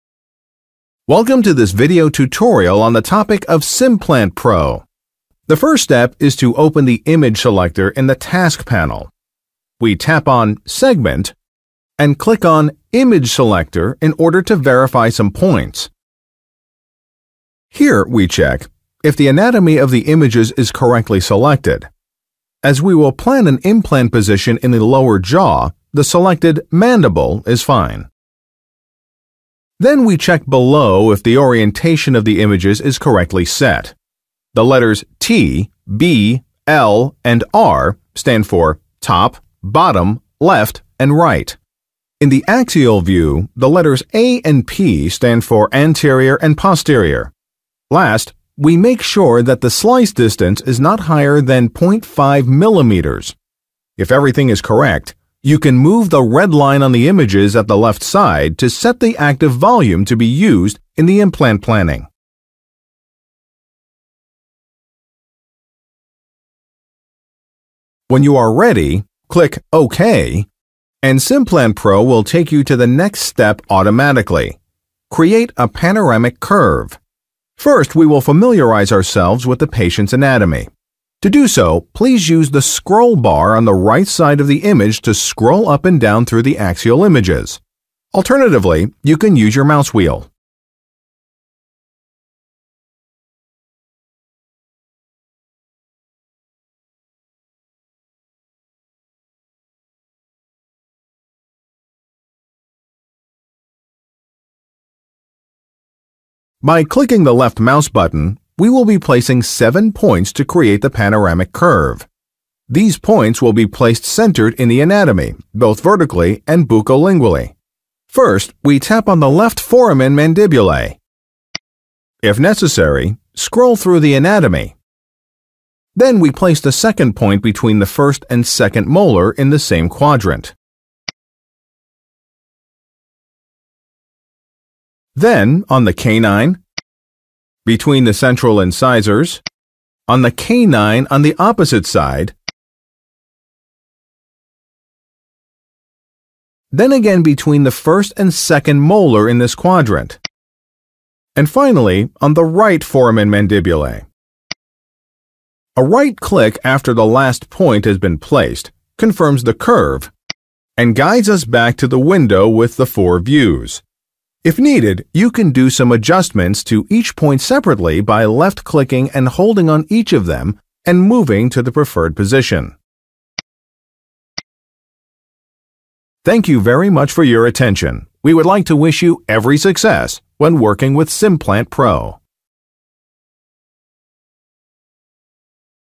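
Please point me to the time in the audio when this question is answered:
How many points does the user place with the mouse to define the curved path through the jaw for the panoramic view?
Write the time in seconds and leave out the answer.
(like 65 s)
109 s.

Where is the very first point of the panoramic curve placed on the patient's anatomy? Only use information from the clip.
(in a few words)
left foramen mandibulae.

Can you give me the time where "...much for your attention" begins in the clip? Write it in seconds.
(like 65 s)
176 s.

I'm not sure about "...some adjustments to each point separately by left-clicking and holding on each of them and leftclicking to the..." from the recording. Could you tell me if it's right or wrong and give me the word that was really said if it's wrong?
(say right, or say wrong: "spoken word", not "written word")
wrong: "moving", not "leftclicking".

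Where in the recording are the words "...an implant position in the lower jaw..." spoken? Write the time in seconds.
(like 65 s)
23 s.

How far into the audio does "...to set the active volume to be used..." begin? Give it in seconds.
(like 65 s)
58 s.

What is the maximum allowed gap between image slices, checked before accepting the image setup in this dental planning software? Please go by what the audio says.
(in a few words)
0.5 millimeters.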